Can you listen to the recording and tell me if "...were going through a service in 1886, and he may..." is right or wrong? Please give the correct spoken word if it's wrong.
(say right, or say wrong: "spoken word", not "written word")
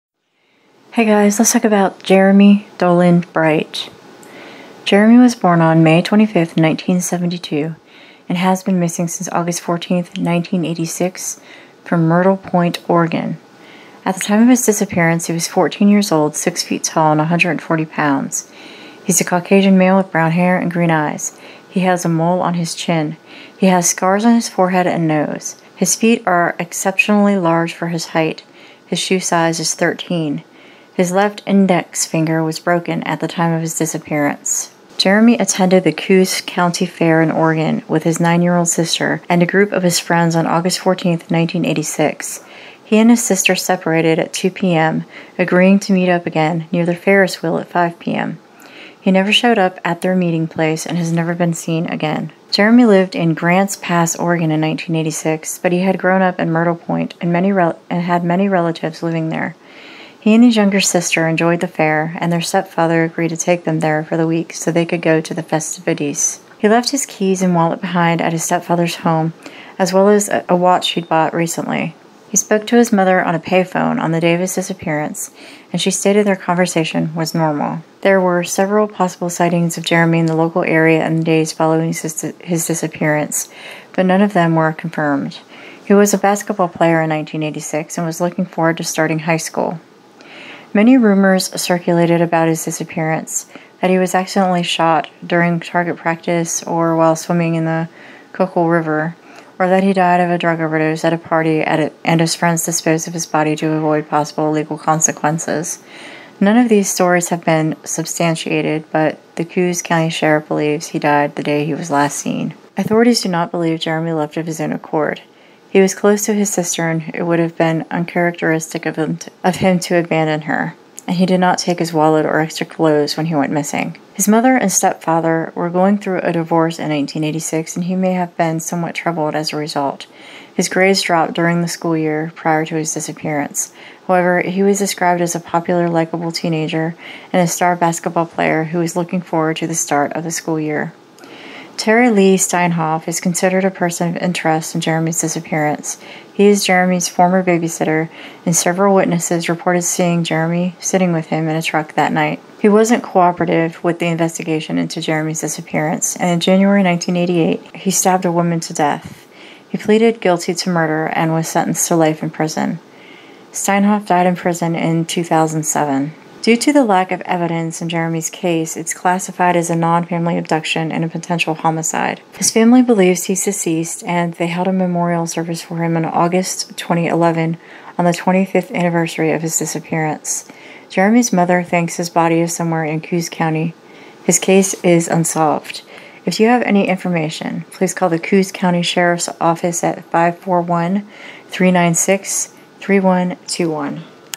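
wrong: "divorce", not "service".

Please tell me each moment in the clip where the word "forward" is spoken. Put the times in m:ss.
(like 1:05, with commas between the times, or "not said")
1:28, 2:19.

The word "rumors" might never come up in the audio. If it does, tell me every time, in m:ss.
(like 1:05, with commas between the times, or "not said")
1:30.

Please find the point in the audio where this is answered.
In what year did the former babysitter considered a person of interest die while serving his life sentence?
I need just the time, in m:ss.
2:45.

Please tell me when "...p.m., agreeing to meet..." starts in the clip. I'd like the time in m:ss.
0:44.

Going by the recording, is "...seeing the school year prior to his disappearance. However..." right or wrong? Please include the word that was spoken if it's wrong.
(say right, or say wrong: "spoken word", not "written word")
wrong: "during", not "seeing".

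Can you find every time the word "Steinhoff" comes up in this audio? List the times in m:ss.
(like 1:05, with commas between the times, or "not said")
2:22, 2:43.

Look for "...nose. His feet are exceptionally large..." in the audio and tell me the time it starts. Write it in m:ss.
0:25.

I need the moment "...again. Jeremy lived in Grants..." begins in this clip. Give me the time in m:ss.
0:51.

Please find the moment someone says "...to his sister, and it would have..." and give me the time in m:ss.
1:56.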